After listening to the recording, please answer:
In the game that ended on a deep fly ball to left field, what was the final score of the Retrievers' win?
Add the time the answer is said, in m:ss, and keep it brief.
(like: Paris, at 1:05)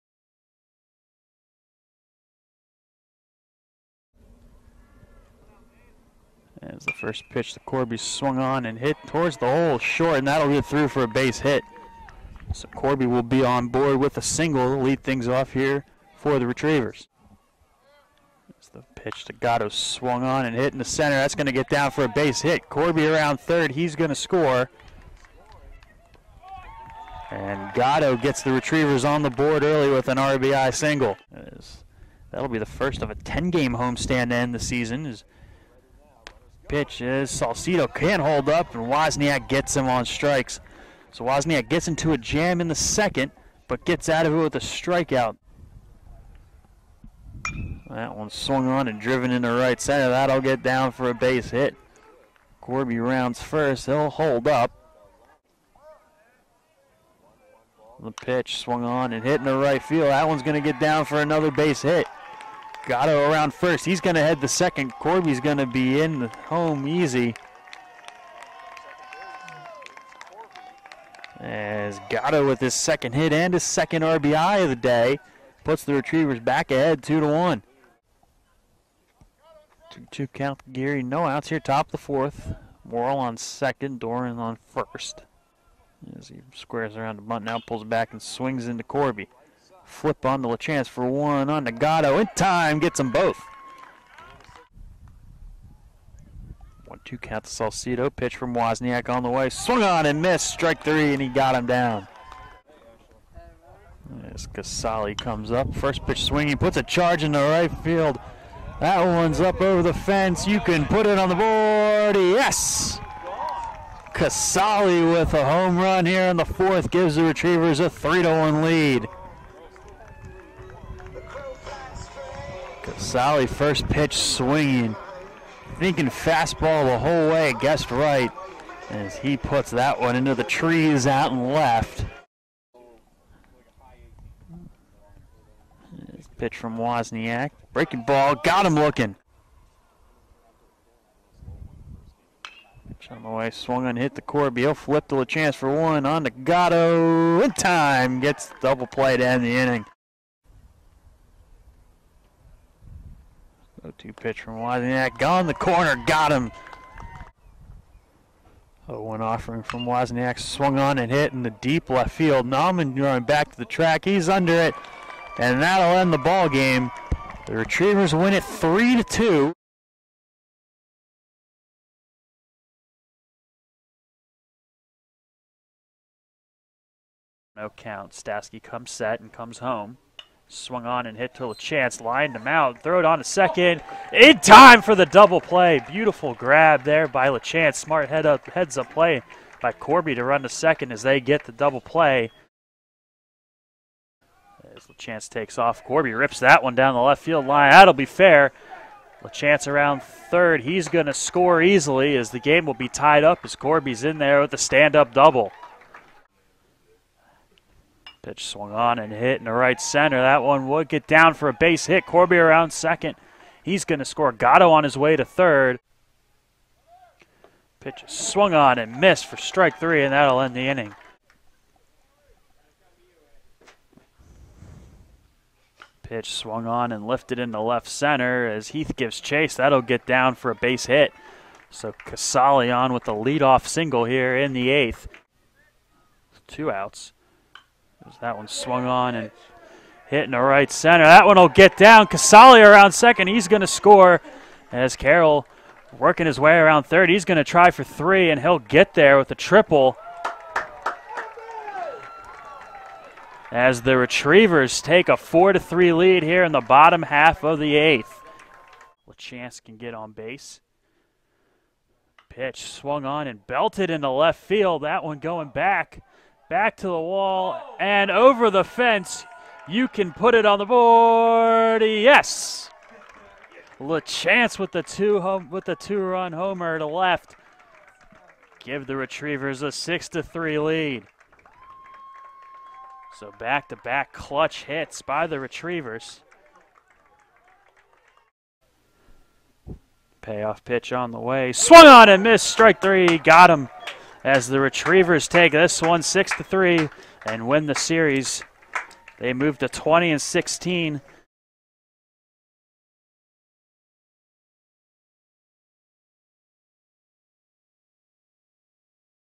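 3 to 2, at 2:48.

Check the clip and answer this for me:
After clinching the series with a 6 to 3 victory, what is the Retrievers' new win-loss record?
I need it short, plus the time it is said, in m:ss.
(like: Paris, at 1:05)
20-16, at 4:59.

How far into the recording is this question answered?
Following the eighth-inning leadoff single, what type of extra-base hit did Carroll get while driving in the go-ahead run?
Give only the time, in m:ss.
4:09.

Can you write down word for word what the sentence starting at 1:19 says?
Two, two count Geary, no outs here, top of the fourth.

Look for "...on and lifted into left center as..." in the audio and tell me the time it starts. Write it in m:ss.
3:46.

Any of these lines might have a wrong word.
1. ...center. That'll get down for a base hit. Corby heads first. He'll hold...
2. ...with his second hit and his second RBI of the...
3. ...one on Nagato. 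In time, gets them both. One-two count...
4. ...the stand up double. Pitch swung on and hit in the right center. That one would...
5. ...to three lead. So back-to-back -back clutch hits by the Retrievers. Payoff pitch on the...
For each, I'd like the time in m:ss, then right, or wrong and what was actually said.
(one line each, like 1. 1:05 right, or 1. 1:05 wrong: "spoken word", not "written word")
1. 0:49 wrong: "rounds", not "heads"
2. 1:12 right
3. 1:31 right
4. 3:24 right
5. 4:40 right.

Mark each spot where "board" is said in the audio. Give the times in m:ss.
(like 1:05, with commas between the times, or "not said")
0:13, 0:29, 1:51, 4:30.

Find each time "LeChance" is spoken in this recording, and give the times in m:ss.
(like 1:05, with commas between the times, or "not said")
3:07, 3:14, 3:19, 4:33.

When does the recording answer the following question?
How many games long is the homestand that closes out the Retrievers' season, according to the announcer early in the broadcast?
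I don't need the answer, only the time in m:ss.
0:33.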